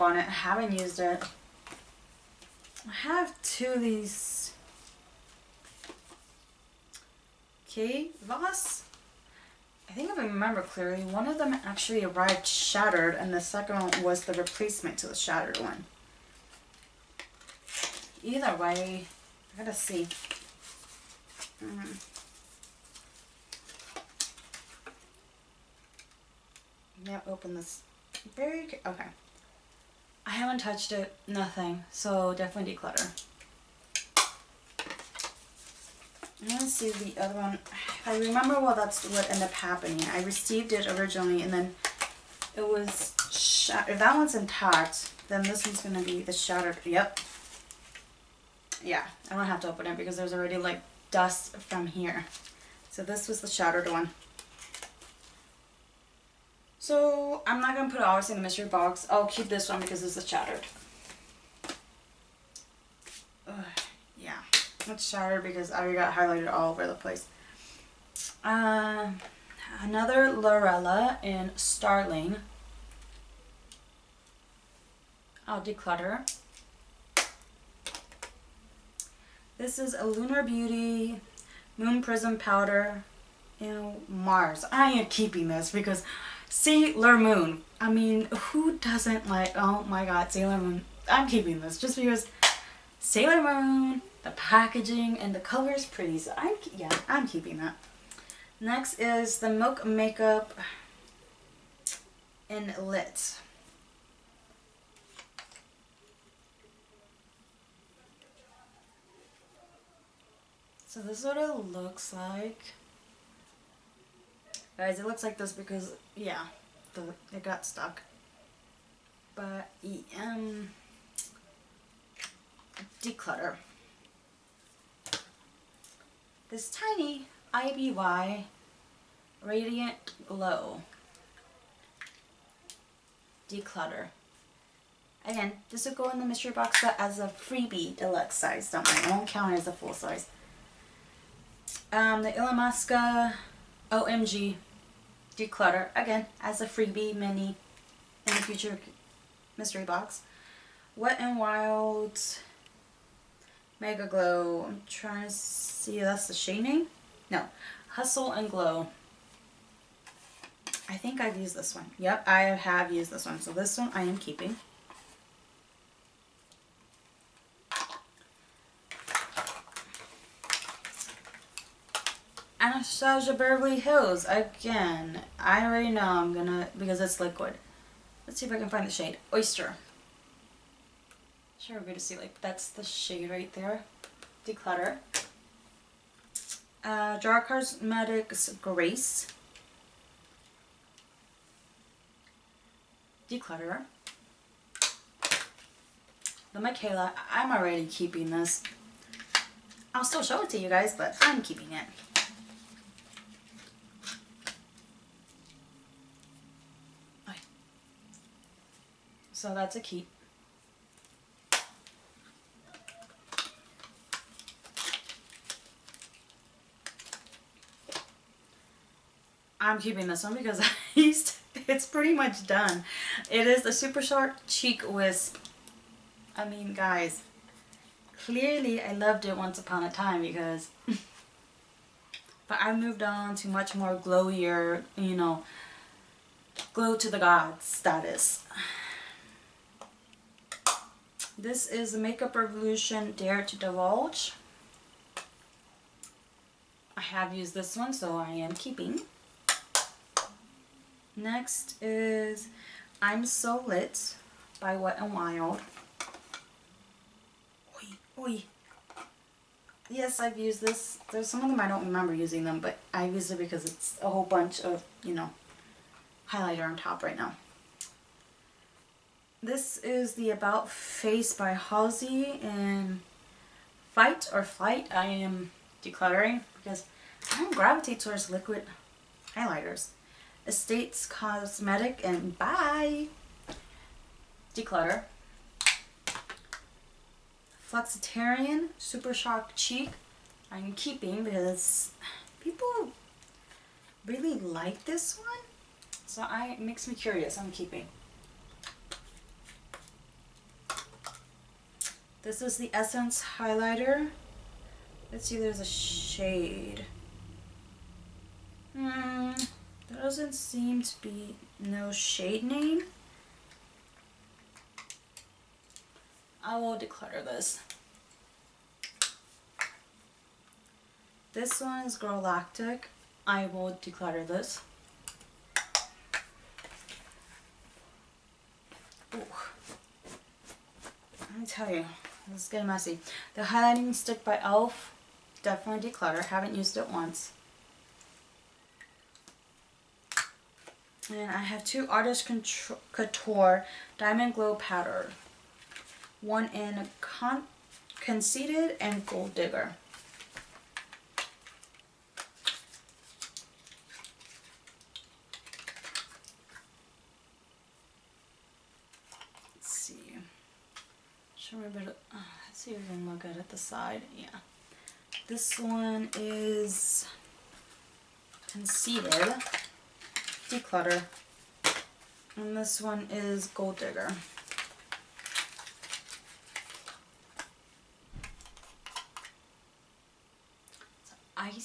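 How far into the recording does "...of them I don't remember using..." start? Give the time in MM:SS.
04:21.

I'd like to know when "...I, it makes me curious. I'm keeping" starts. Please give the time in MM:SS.
04:56.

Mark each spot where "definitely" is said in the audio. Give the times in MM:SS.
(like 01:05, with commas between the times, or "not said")
00:32, 05:35.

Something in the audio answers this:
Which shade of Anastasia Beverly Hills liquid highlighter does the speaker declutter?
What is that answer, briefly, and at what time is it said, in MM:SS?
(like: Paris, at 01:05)
Oyster, at 02:59.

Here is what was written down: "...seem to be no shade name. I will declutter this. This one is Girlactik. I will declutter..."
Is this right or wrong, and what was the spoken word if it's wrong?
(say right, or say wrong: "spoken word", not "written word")
right.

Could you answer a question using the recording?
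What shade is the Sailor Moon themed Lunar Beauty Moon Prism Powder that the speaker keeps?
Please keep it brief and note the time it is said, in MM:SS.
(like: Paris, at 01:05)
Mars, at 01:24.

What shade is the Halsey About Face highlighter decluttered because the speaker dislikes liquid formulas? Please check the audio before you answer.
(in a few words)
Fight or Flight.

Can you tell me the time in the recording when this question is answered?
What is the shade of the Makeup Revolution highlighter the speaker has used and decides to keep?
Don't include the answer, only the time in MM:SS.
04:03.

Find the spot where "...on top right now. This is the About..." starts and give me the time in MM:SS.
04:26.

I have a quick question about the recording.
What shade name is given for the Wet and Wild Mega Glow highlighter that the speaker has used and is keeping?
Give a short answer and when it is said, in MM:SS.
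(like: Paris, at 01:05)
Hustle and Glow, at 02:37.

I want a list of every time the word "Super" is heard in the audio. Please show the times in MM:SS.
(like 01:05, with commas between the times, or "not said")
03:43, 04:48.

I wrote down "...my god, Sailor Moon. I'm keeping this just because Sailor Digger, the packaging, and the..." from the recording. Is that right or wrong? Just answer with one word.
wrong.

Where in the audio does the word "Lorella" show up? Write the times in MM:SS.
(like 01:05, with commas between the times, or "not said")
01:10.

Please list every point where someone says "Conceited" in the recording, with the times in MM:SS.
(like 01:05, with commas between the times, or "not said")
05:48, 06:08.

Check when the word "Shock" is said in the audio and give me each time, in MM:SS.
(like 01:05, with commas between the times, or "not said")
03:44, 04:49.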